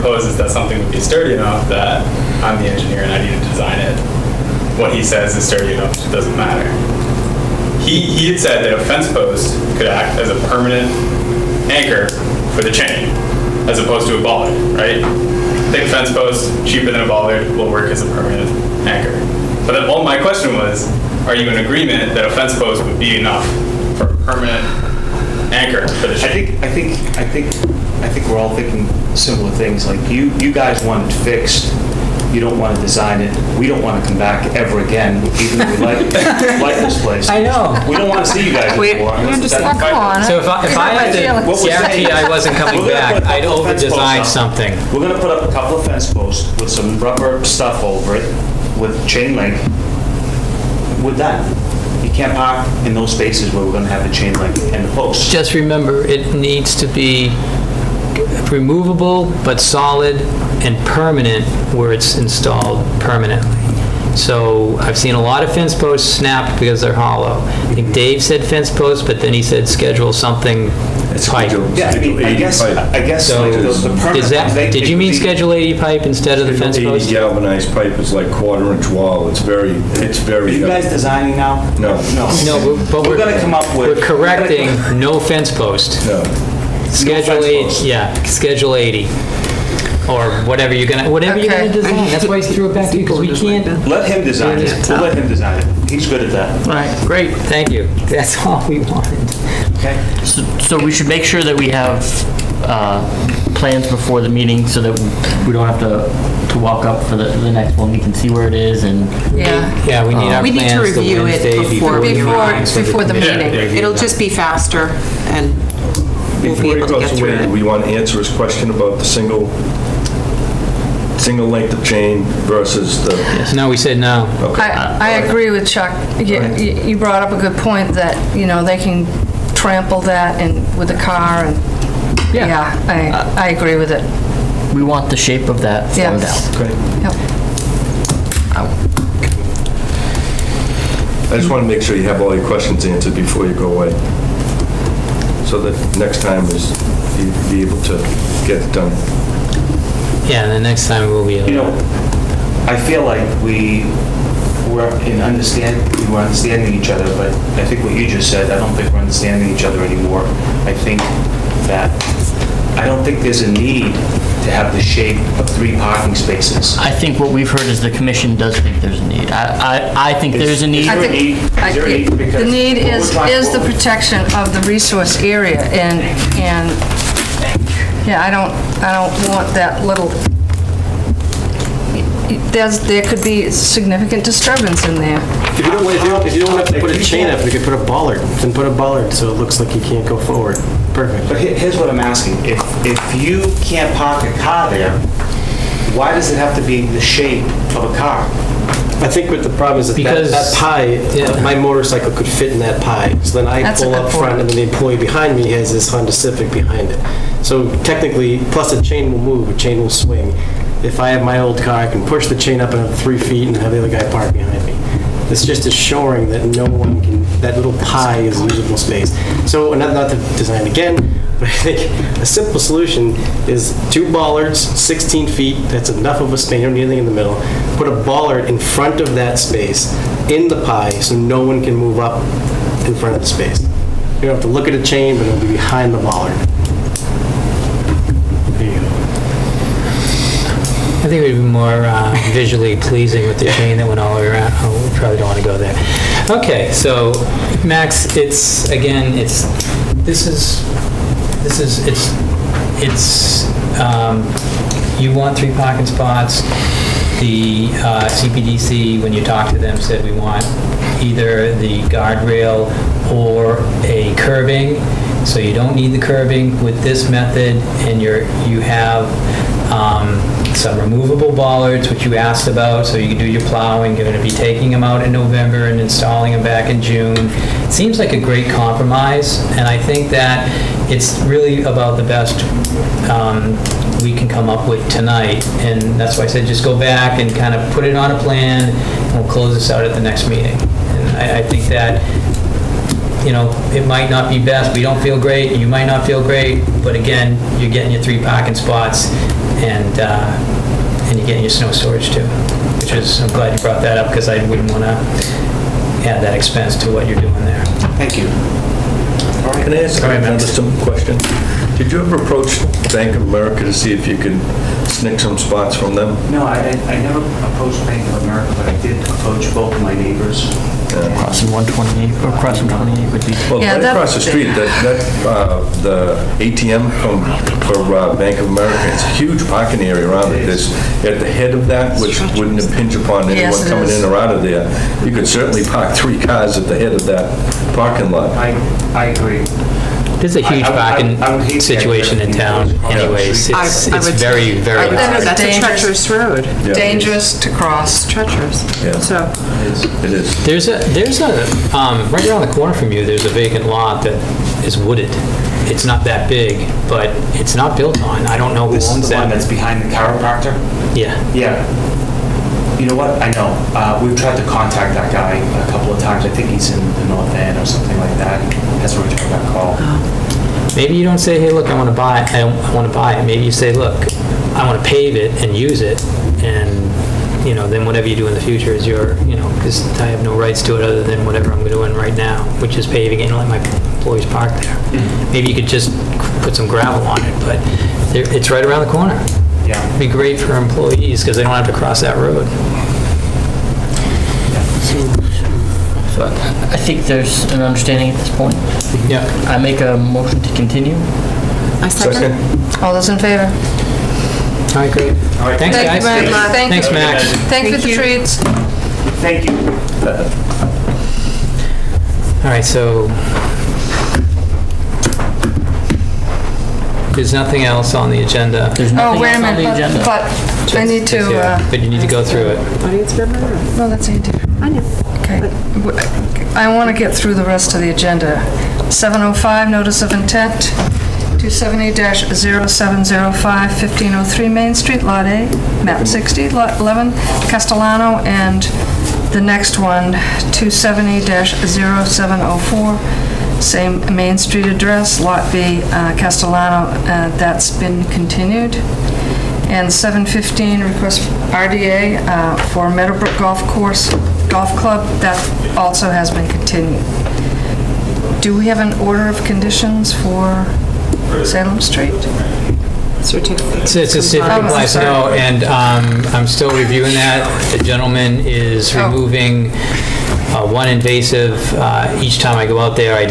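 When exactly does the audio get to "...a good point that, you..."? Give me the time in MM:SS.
02:07.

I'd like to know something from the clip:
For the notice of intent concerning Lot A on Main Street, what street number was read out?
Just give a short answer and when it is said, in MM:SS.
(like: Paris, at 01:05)
1503, at 07:13.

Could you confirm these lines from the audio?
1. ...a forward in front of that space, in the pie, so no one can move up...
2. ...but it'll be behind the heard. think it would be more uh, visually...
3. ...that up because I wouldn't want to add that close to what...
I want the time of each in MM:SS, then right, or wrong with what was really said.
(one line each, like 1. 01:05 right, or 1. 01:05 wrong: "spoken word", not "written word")
1. 03:47 wrong: "bollard", not "forward"
2. 03:55 wrong: "bollard", not "heard"
3. 05:03 wrong: "expense", not "close".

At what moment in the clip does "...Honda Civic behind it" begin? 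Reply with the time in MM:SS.
03:25.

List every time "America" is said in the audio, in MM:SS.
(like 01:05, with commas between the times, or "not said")
05:13, 05:18, 05:28.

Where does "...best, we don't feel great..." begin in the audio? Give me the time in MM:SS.
04:54.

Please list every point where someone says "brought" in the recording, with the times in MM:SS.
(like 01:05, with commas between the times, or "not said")
02:06, 05:03.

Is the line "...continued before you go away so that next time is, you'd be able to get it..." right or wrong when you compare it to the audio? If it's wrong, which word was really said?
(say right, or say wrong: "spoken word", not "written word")
wrong: "answered", not "continued".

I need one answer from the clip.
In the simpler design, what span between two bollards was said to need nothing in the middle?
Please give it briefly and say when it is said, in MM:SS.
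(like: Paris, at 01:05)
16 feet, at 03:44.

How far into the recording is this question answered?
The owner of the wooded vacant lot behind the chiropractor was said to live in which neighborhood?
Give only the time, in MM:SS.
06:07.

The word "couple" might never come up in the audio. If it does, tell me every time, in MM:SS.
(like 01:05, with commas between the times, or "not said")
00:45, 06:05.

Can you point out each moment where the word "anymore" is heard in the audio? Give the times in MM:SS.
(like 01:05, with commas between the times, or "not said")
00:38, 02:39.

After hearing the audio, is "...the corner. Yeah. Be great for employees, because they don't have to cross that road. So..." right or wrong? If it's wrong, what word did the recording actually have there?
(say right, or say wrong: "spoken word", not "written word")
right.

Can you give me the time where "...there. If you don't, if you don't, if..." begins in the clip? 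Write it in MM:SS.
03:04.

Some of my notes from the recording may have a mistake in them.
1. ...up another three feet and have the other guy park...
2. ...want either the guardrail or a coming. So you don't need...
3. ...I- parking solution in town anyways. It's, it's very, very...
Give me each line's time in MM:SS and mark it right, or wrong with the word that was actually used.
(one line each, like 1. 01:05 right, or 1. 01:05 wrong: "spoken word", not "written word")
1. 03:32 right
2. 04:20 wrong: "curbing", not "coming"
3. 05:40 wrong: "situation", not "solution".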